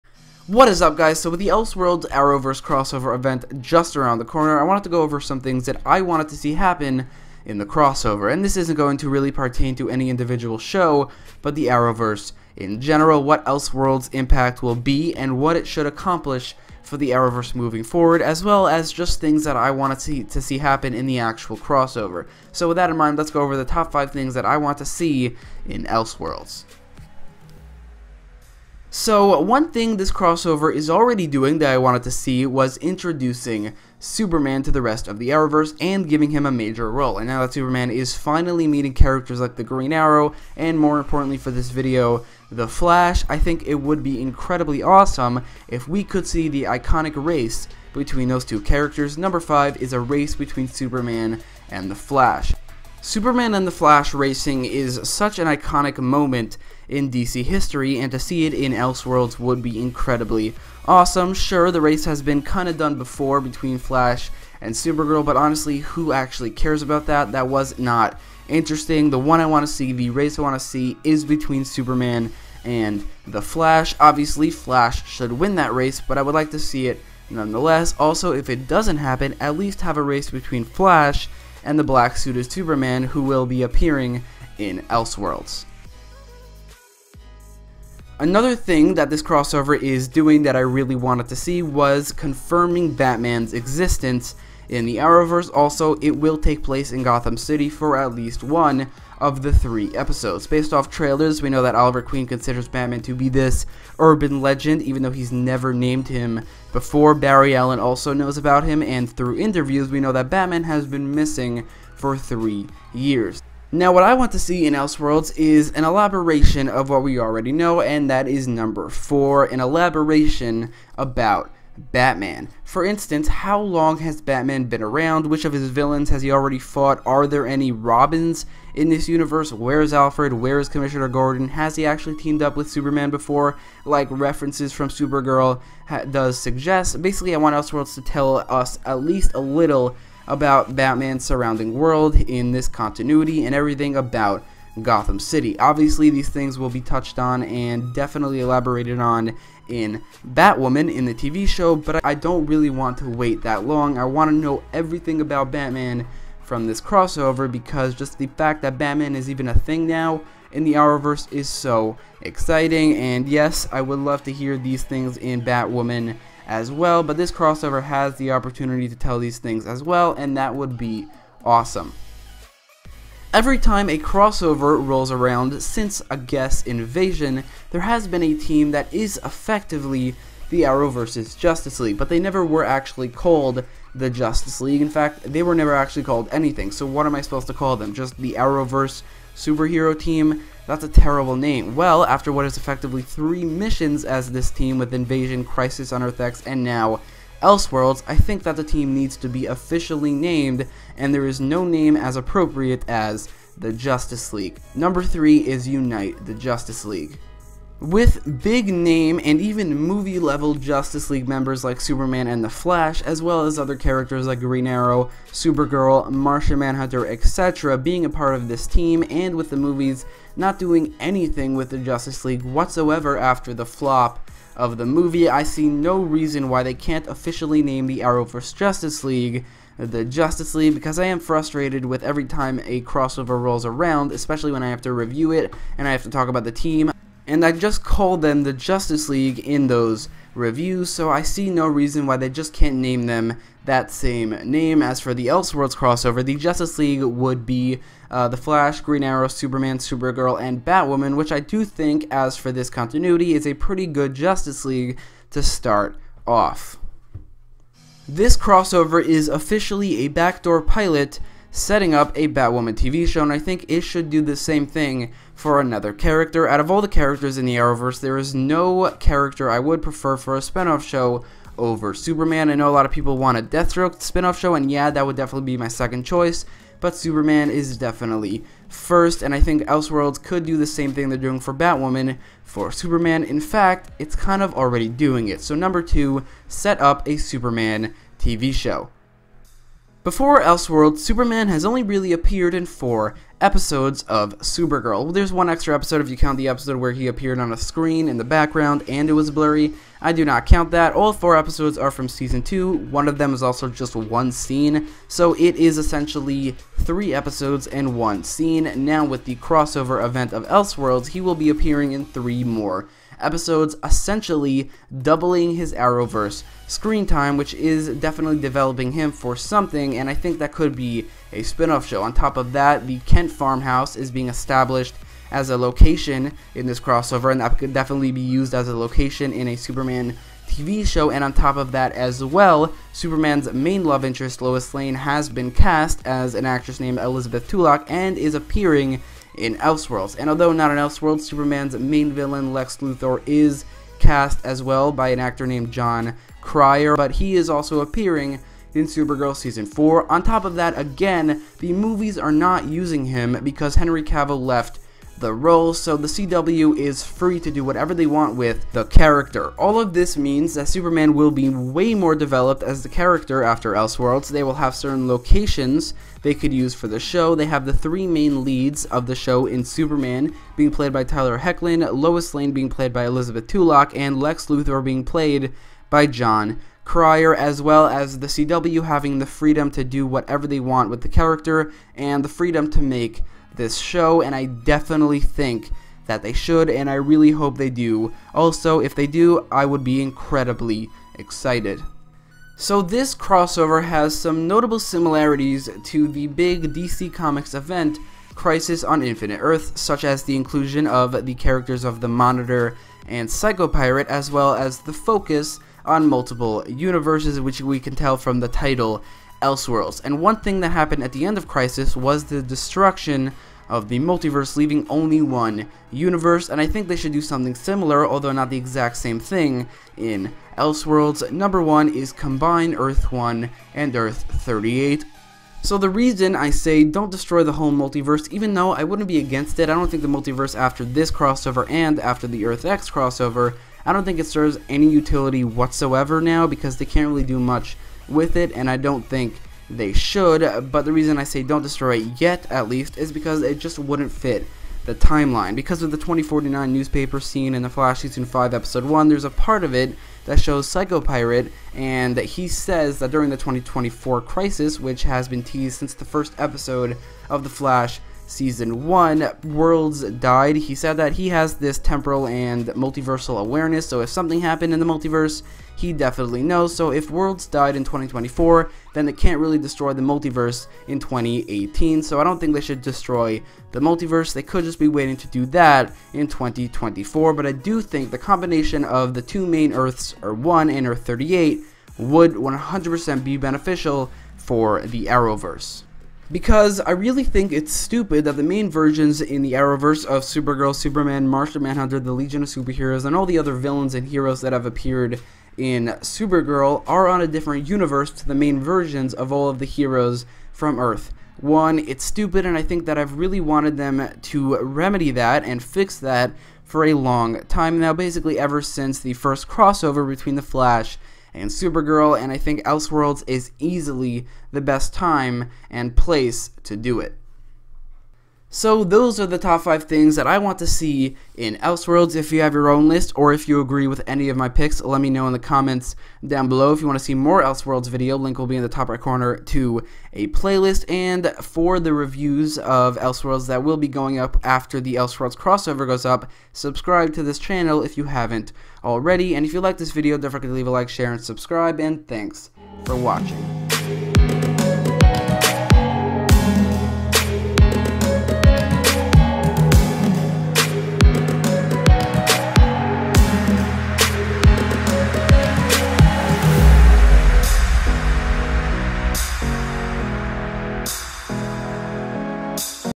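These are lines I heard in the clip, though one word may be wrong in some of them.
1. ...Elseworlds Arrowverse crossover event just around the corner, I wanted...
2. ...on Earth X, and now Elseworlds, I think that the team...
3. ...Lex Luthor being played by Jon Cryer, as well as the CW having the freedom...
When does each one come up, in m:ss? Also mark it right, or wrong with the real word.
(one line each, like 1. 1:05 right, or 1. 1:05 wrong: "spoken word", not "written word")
1. 0:01 right
2. 3:15 right
3. 6:14 right.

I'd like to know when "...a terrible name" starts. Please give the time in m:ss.
3:10.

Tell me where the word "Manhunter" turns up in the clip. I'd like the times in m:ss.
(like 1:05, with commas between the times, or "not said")
3:36, 8:11.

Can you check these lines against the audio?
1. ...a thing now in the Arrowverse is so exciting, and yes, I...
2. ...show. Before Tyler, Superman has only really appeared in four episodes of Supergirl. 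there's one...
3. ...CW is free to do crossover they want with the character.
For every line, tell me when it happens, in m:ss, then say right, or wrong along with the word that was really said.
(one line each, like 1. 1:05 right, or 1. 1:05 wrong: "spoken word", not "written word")
1. 2:39 right
2. 4:48 wrong: "Elseworlds", not "Tyler"
3. 5:56 wrong: "whatever", not "crossover".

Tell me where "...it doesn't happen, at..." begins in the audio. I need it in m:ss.
1:18.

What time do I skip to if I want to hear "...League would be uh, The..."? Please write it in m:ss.
4:06.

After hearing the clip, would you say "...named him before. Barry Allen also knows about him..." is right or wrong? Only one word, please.
right.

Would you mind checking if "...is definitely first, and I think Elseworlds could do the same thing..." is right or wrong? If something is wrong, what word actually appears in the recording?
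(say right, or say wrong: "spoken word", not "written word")
right.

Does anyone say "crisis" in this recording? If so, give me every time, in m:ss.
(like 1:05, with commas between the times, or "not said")
3:15, 6:38, 6:51, 7:34.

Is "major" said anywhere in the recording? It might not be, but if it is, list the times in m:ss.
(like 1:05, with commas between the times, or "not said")
0:36.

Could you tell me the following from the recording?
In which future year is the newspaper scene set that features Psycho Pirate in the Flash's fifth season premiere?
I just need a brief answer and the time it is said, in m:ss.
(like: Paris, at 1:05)
2049, at 7:25.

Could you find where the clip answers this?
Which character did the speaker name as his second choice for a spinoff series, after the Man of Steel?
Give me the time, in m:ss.
4:33.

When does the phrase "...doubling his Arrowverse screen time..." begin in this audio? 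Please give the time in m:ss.
5:15.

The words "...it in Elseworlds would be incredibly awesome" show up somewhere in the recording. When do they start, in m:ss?
0:58.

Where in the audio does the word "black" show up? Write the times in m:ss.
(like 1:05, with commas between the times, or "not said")
1:21.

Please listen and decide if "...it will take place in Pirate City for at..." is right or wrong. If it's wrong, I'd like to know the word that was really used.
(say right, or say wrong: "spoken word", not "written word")
wrong: "Gotham", not "Pirate".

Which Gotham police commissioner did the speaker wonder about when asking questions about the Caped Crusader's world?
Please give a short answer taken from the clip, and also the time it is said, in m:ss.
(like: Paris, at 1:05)
Commissioner Gordon, at 2:10.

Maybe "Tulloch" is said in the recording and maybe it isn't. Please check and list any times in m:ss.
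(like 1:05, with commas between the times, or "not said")
5:37, 6:13.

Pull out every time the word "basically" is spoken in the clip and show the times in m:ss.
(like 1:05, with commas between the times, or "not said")
2:17, 8:27.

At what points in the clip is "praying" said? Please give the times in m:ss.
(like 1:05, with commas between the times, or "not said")
not said.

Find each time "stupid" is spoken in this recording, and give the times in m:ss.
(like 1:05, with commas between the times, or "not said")
8:07, 8:22.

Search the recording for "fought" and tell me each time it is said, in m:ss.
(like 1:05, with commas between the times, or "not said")
2:06.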